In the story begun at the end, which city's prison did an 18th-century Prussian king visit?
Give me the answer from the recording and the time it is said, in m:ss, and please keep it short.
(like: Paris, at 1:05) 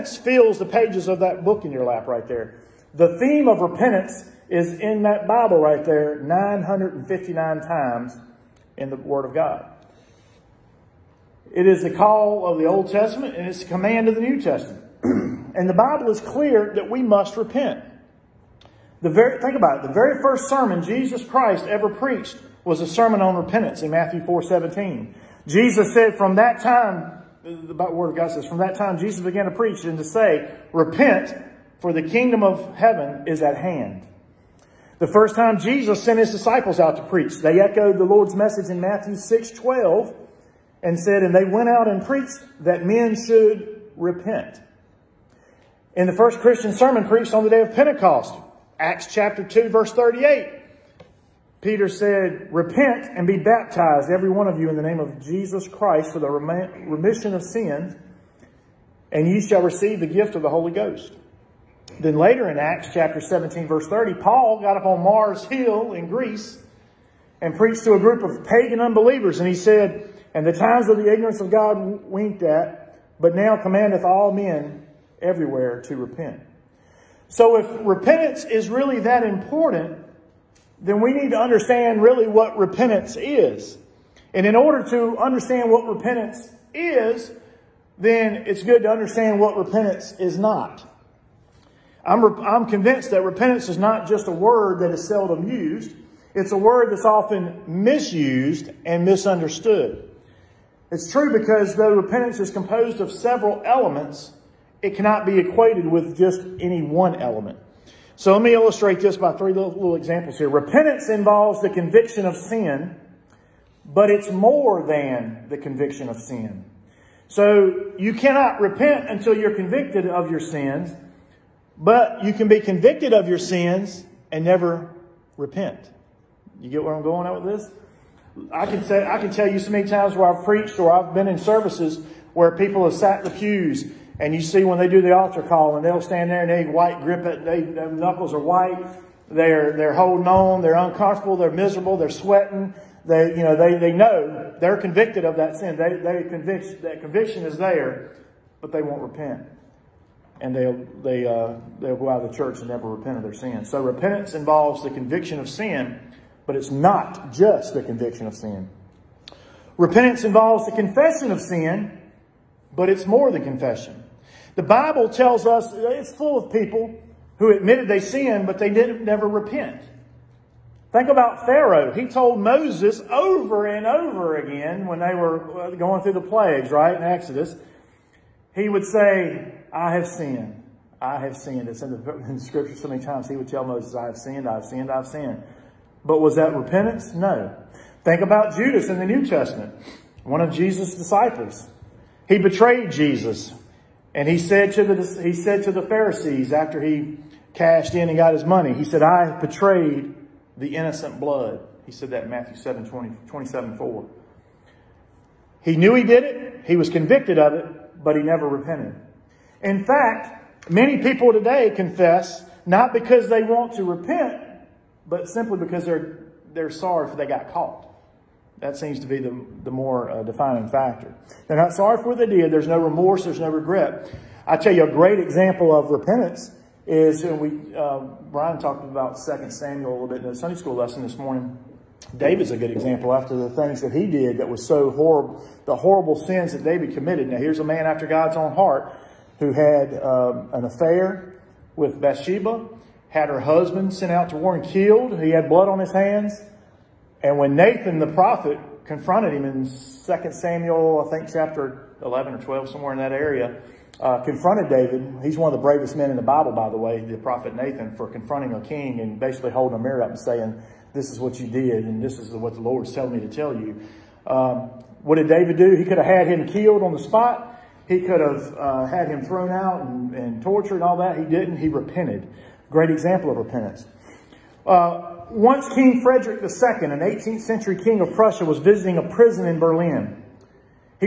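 Berlin, at 4:39.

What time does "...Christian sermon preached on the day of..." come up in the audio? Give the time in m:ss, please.
0:46.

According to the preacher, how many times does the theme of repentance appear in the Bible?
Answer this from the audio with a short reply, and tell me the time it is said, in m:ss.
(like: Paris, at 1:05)
959, at 0:06.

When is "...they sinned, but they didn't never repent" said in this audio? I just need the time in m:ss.
2:47.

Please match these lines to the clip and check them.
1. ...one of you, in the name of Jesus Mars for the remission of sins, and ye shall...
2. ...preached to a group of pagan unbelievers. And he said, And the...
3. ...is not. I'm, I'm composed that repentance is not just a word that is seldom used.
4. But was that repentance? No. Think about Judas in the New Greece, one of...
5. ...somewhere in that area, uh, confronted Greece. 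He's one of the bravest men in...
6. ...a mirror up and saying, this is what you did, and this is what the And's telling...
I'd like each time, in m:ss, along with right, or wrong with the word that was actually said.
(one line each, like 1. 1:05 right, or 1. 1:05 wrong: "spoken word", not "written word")
1. 0:54 wrong: "Christ", not "Mars"
2. 1:07 right
3. 1:30 wrong: "convinced", not "composed"
4. 3:06 wrong: "Testament", not "Greece"
5. 4:12 wrong: "David", not "Greece"
6. 4:19 wrong: "Lord", not "And".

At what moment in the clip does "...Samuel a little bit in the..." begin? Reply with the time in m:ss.
3:49.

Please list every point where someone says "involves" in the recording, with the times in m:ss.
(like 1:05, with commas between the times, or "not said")
1:51, 2:34, 2:40.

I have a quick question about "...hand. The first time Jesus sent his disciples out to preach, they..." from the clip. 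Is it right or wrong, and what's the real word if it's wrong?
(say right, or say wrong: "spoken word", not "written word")
right.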